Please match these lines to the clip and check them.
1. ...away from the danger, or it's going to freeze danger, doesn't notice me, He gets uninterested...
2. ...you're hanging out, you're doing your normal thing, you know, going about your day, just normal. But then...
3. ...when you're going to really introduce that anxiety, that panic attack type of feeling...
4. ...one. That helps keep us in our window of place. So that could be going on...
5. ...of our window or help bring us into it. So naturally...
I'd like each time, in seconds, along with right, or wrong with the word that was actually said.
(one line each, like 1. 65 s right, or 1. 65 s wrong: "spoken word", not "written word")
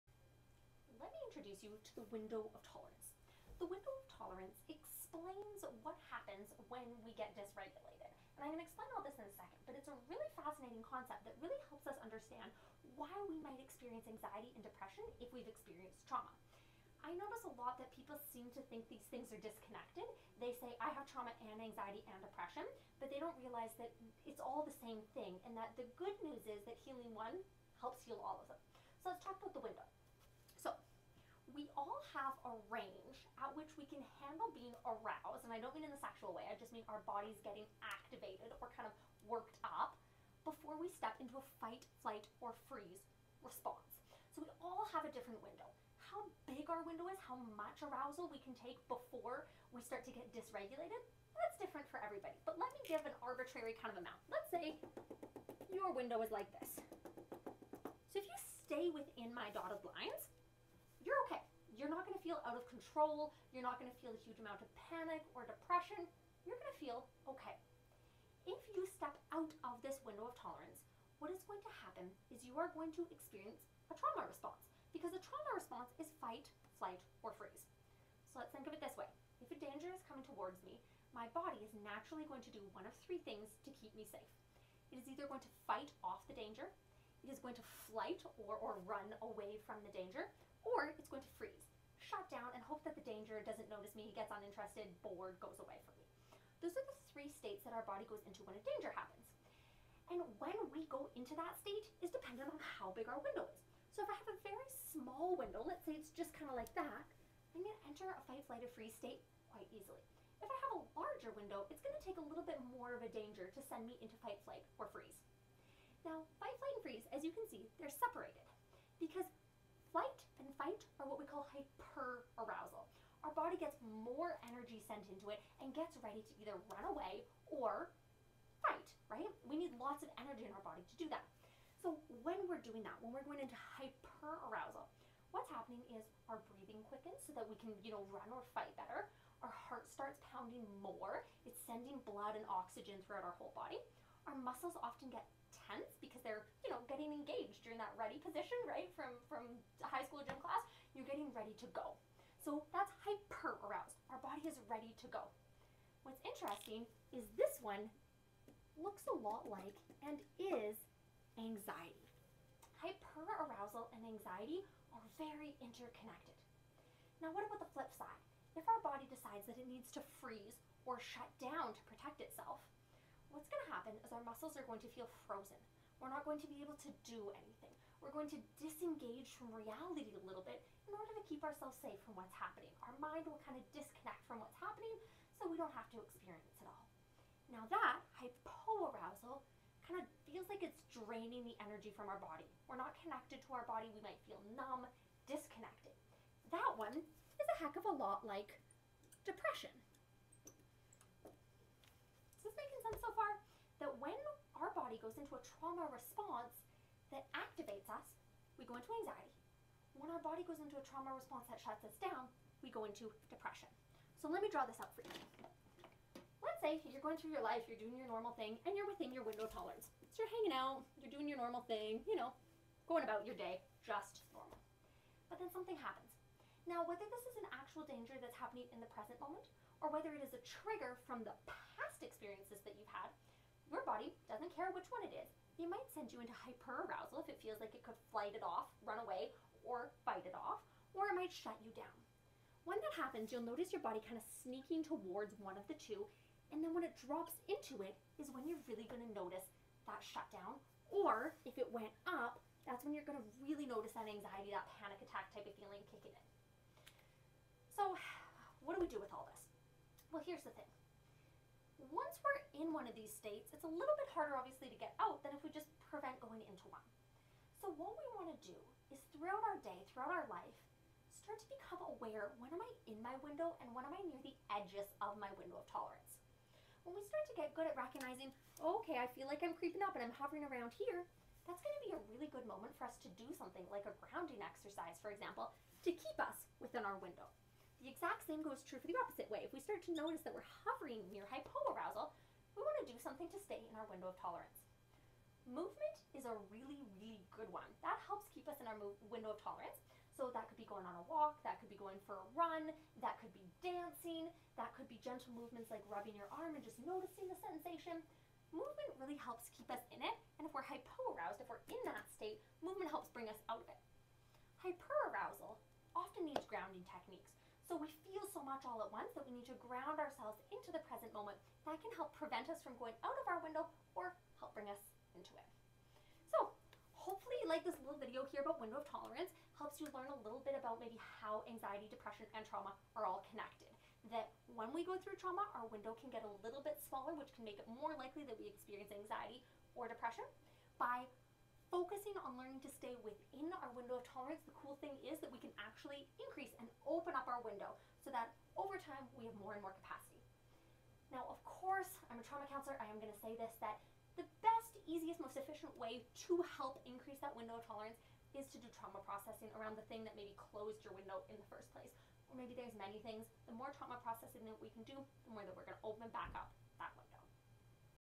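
1. 89 s right
2. 220 s right
3. 252 s wrong: "notice", not "introduce"
4. 297 s wrong: "tolerance", not "place"
5. 323 s wrong: "hopefully", not "naturally".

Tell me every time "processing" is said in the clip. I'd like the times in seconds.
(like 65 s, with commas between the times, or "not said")
359 s, 364 s.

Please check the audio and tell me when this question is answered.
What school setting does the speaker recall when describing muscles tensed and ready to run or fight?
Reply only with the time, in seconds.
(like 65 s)
149 s.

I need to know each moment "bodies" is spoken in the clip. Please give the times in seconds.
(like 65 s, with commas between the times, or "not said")
37 s.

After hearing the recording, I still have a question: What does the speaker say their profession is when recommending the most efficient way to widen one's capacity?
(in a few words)
trauma counselor.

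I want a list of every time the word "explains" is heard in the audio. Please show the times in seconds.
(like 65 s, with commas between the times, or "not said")
4 s, 8 s.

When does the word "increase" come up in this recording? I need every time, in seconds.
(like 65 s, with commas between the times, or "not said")
346 s, 356 s.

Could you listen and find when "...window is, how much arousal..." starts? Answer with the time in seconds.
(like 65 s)
46 s.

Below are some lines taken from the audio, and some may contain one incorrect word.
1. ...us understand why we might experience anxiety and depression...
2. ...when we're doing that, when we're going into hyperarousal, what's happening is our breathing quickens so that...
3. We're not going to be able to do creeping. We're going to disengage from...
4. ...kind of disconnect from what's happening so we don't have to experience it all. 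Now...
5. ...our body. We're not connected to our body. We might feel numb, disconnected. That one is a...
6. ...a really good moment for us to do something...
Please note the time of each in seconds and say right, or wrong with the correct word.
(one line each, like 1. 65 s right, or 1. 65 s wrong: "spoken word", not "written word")
1. 11 s right
2. 132 s right
3. 176 s wrong: "anything", not "creeping"
4. 183 s right
5. 192 s right
6. 281 s right.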